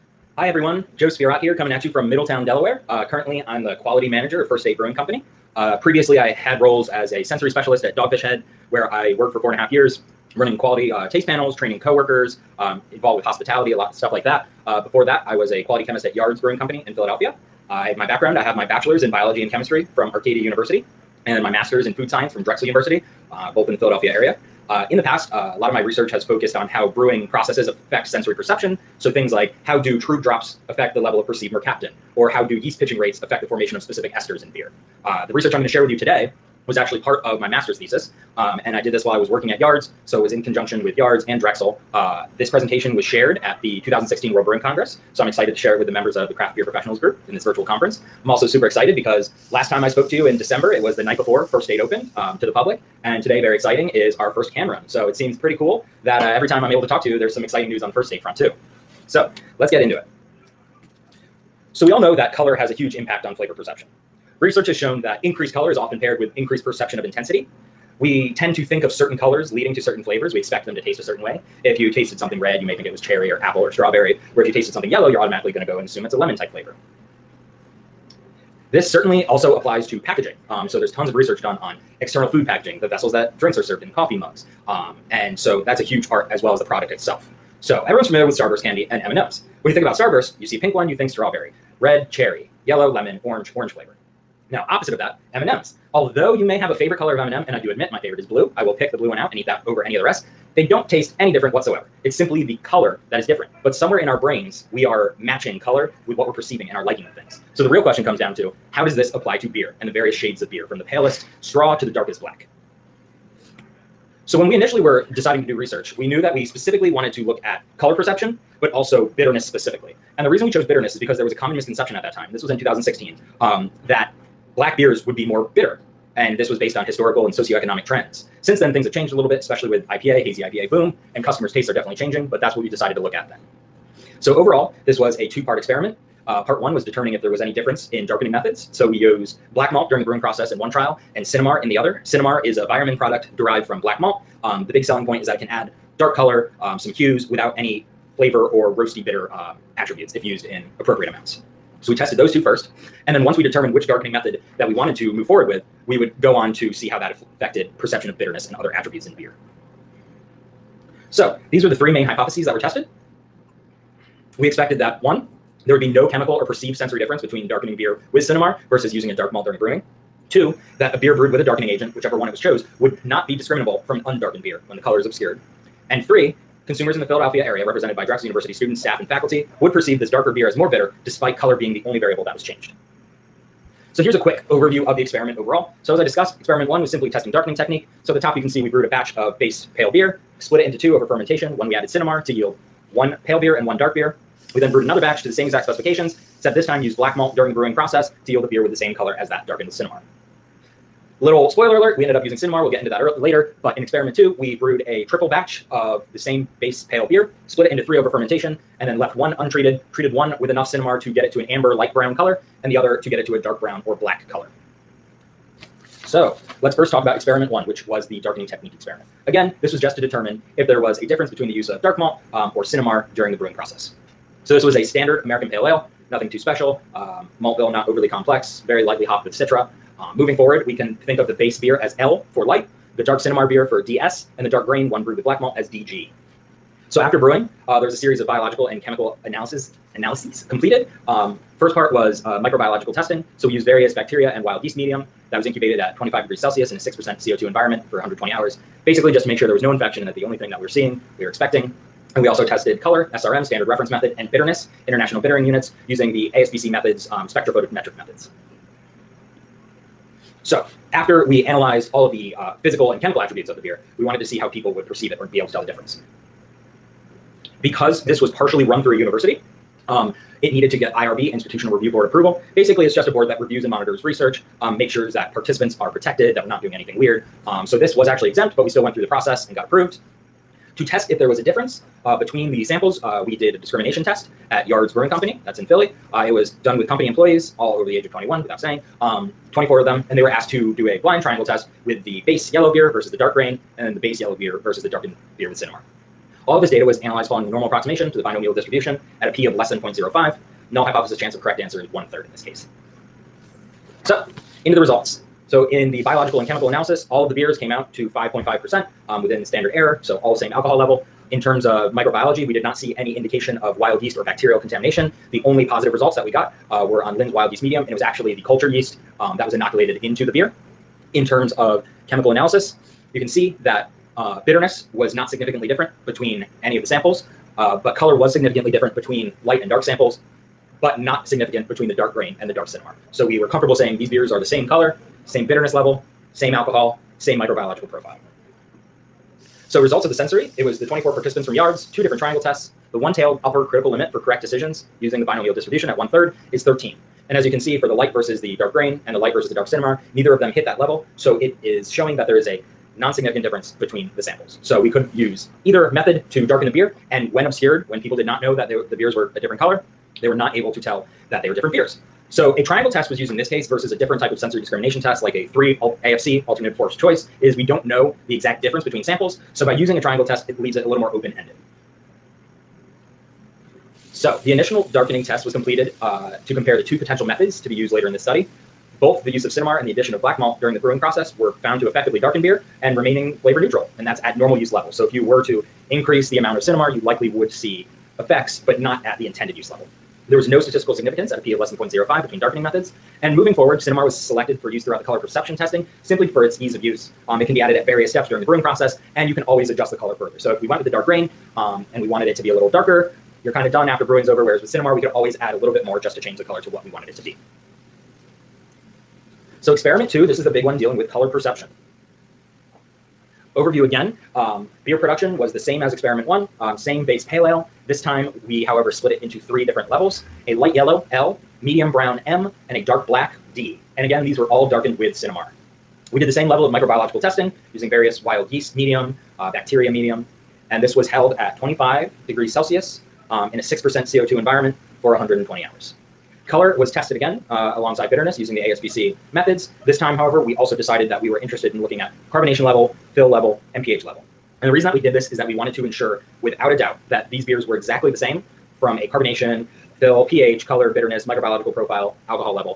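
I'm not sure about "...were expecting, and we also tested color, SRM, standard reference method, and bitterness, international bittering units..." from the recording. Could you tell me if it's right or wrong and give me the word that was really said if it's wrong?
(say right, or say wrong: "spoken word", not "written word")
right.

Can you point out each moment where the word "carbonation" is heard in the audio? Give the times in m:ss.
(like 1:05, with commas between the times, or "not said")
7:22, 7:29.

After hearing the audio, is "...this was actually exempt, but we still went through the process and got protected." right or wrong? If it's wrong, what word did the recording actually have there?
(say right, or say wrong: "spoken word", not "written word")
wrong: "approved", not "protected".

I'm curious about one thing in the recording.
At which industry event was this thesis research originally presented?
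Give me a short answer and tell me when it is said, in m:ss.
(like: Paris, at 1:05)
2016 World Brewing Congress, at 0:43.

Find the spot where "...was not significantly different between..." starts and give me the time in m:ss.
5:24.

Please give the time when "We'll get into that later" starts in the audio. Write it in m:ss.
3:22.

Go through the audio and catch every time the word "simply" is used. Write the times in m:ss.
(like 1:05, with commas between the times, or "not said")
1:42, 3:06, 6:36.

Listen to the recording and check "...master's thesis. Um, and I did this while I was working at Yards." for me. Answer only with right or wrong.
right.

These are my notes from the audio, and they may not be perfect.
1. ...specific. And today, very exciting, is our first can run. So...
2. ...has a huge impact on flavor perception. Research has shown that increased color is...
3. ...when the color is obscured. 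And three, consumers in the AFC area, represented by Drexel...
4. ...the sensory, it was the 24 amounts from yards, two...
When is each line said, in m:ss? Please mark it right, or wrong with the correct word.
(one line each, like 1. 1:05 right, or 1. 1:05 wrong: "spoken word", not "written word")
1. 0:52 wrong: "public", not "specific"
2. 1:02 right
3. 2:54 wrong: "Philadelphia", not "AFC"
4. 5:40 wrong: "participants", not "amounts".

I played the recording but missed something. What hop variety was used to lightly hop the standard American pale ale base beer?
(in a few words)
Citra.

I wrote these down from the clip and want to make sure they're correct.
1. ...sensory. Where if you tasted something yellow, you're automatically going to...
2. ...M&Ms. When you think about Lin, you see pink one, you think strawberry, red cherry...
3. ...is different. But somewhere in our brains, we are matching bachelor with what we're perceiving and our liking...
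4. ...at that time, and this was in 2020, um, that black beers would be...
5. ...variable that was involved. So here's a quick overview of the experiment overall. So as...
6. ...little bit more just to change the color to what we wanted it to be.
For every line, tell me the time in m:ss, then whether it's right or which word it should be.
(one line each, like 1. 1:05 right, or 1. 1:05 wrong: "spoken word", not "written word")
1. 1:13 wrong: "strawberry", not "sensory"
2. 1:29 wrong: "Starburst", not "Lin"
3. 1:43 wrong: "color", not "bachelor"
4. 2:01 wrong: "2016", not "2020"
5. 3:01 wrong: "changed", not "involved"
6. 6:45 right.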